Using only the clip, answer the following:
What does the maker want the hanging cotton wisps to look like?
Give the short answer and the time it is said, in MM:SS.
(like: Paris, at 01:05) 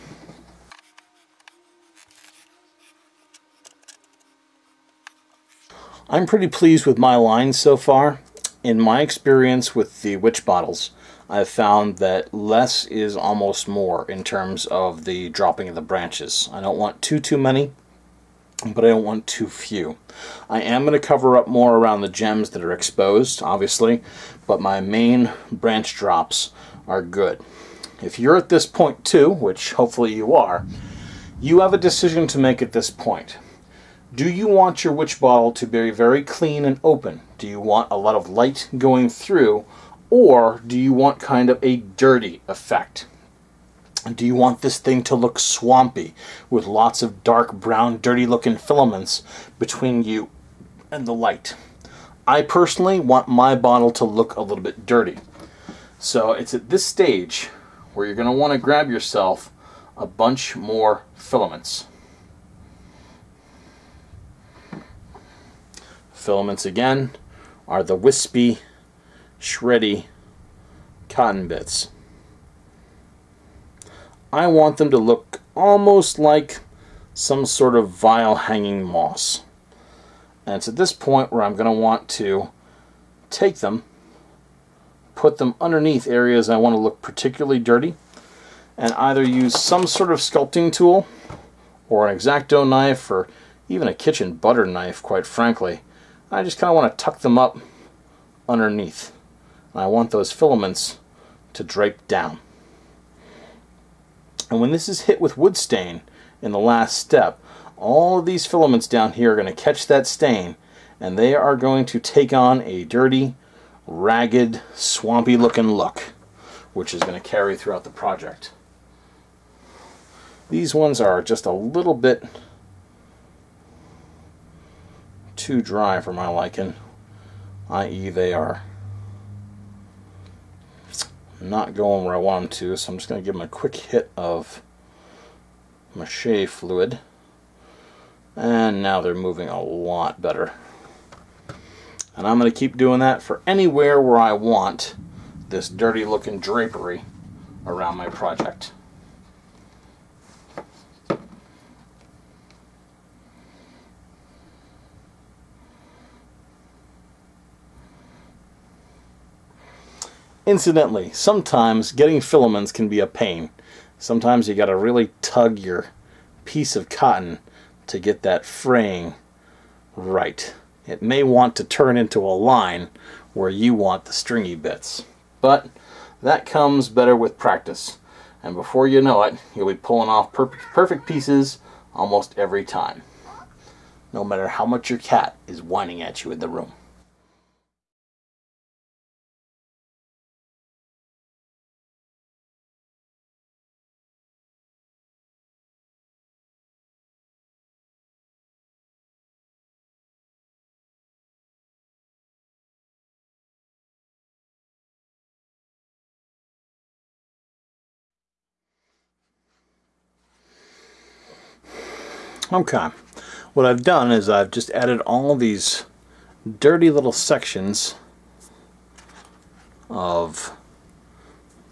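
Hanging moss, at 01:18.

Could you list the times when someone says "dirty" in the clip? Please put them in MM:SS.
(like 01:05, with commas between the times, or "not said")
00:41, 00:48, 00:54, 01:27, 01:52, 02:25, 03:36.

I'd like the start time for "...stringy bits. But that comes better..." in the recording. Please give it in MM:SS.
02:54.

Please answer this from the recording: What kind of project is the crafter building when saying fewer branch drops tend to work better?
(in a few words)
Witch bottle.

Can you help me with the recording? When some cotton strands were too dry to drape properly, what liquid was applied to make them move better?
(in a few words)
Mache fluid.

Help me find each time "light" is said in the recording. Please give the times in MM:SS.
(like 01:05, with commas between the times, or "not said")
00:38, 00:51.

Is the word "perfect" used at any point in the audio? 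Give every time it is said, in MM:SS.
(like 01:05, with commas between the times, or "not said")
03:00.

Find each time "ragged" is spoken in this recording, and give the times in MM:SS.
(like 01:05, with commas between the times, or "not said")
01:53.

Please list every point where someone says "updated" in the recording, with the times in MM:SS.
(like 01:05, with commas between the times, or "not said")
not said.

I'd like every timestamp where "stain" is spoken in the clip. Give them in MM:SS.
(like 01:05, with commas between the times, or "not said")
01:45, 01:50.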